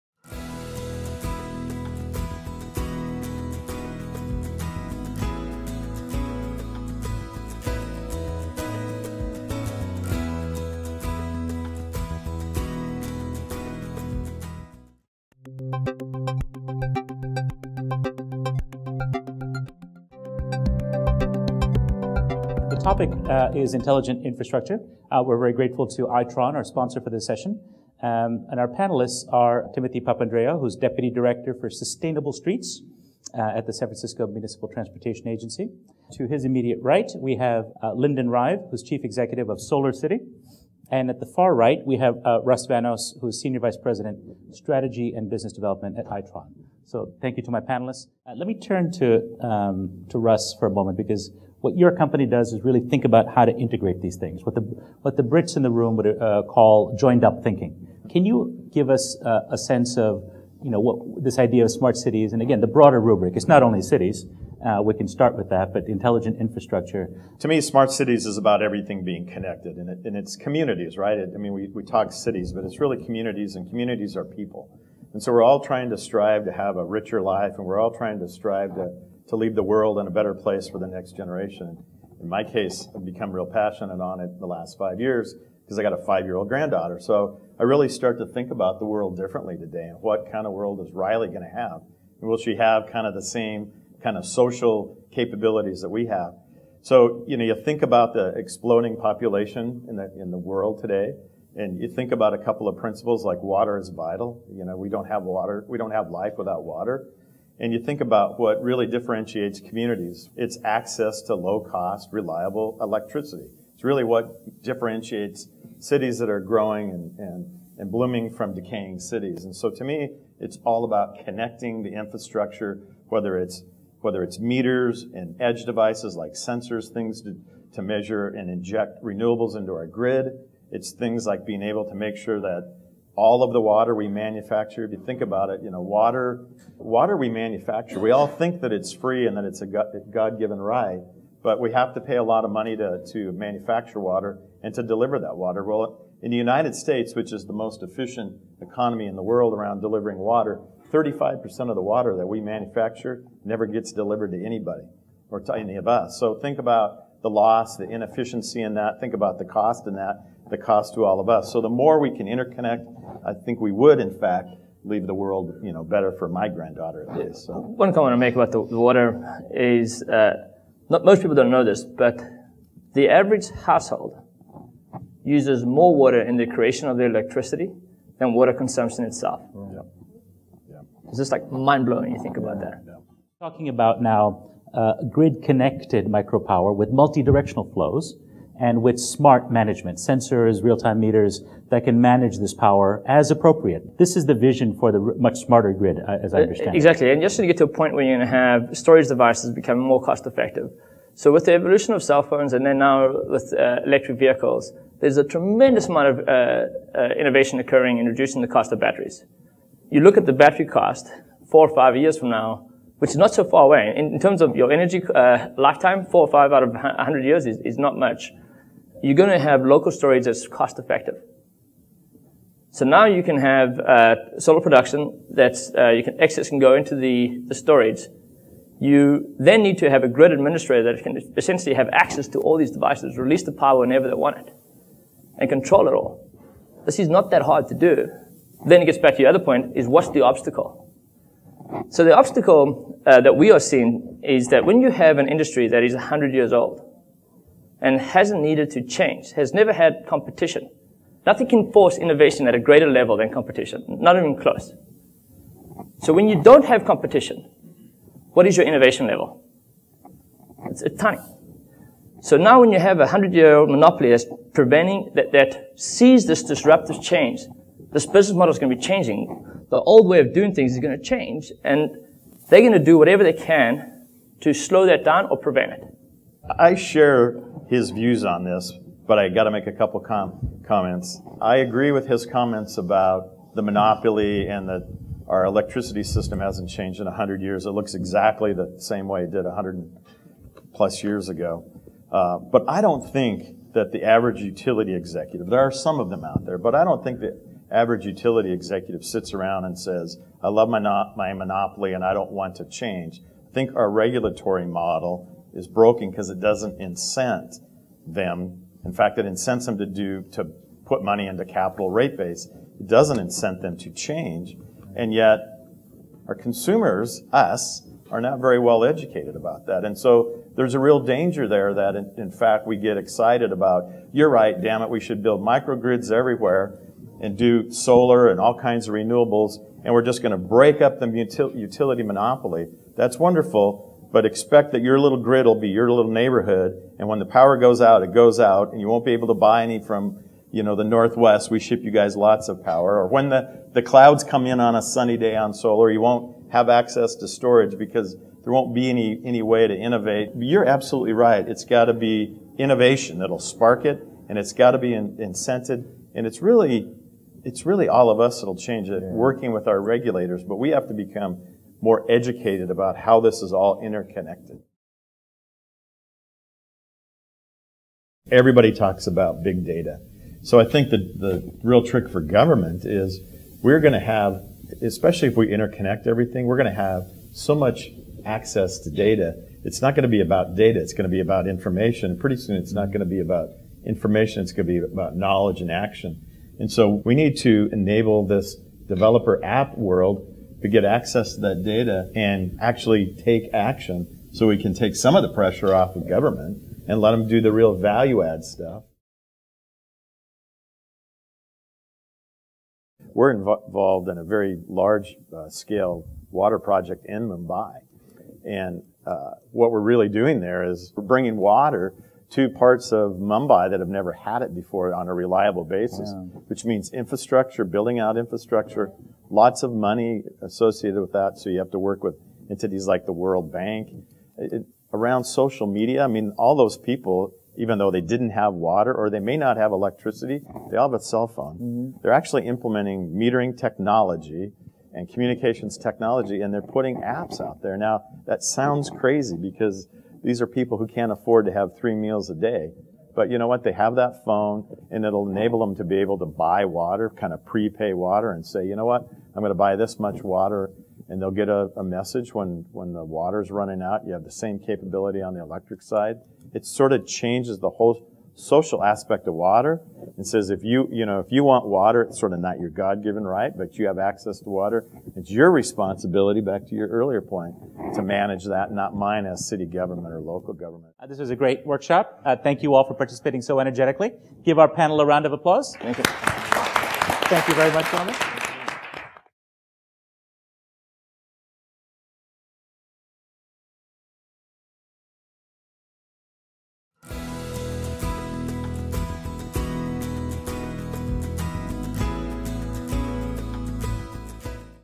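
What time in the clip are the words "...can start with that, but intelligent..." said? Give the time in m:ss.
1:04.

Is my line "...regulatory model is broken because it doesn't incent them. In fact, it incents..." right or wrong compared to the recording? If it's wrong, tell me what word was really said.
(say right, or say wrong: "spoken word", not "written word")
right.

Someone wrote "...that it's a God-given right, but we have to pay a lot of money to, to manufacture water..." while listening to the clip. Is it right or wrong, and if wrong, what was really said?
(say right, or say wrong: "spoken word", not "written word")
right.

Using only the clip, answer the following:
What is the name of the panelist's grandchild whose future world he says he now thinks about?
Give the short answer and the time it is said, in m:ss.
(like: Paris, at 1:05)
Riley, at 1:30.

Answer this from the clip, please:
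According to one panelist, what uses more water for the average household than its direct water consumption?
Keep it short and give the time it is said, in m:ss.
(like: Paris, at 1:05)
creation of the electricity, at 2:56.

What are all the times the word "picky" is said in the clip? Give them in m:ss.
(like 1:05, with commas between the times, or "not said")
not said.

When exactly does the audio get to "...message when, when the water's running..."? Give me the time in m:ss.
7:31.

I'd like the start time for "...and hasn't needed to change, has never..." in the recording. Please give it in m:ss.
4:07.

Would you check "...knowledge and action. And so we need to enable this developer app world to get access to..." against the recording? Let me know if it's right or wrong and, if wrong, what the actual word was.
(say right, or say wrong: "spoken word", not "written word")
right.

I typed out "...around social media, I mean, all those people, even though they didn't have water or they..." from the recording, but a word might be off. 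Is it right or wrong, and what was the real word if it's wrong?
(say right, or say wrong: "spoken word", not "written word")
right.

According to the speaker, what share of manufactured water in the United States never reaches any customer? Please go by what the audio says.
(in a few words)
35%.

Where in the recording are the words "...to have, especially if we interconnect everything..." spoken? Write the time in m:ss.
6:13.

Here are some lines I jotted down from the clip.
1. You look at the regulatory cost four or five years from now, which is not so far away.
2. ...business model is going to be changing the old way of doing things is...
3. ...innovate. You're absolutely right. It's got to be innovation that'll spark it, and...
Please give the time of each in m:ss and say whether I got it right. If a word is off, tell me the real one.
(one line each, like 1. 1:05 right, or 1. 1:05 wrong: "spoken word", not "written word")
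1. 3:29 wrong: "battery", not "regulatory"
2. 4:28 right
3. 5:49 right.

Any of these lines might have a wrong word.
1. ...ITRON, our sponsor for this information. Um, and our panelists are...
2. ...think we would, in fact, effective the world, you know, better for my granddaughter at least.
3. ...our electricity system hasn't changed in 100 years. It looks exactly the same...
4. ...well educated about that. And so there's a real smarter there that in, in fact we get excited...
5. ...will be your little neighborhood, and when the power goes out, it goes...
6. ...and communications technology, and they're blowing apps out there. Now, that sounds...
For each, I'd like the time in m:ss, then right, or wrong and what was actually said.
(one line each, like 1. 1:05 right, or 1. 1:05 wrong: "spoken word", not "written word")
1. 0:26 wrong: "session", not "information"
2. 2:43 wrong: "leave", not "effective"
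3. 4:45 right
4. 5:18 wrong: "danger", not "smarter"
5. 5:35 right
6. 7:14 wrong: "putting", not "blowing".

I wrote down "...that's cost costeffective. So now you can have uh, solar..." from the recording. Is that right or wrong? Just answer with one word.
wrong.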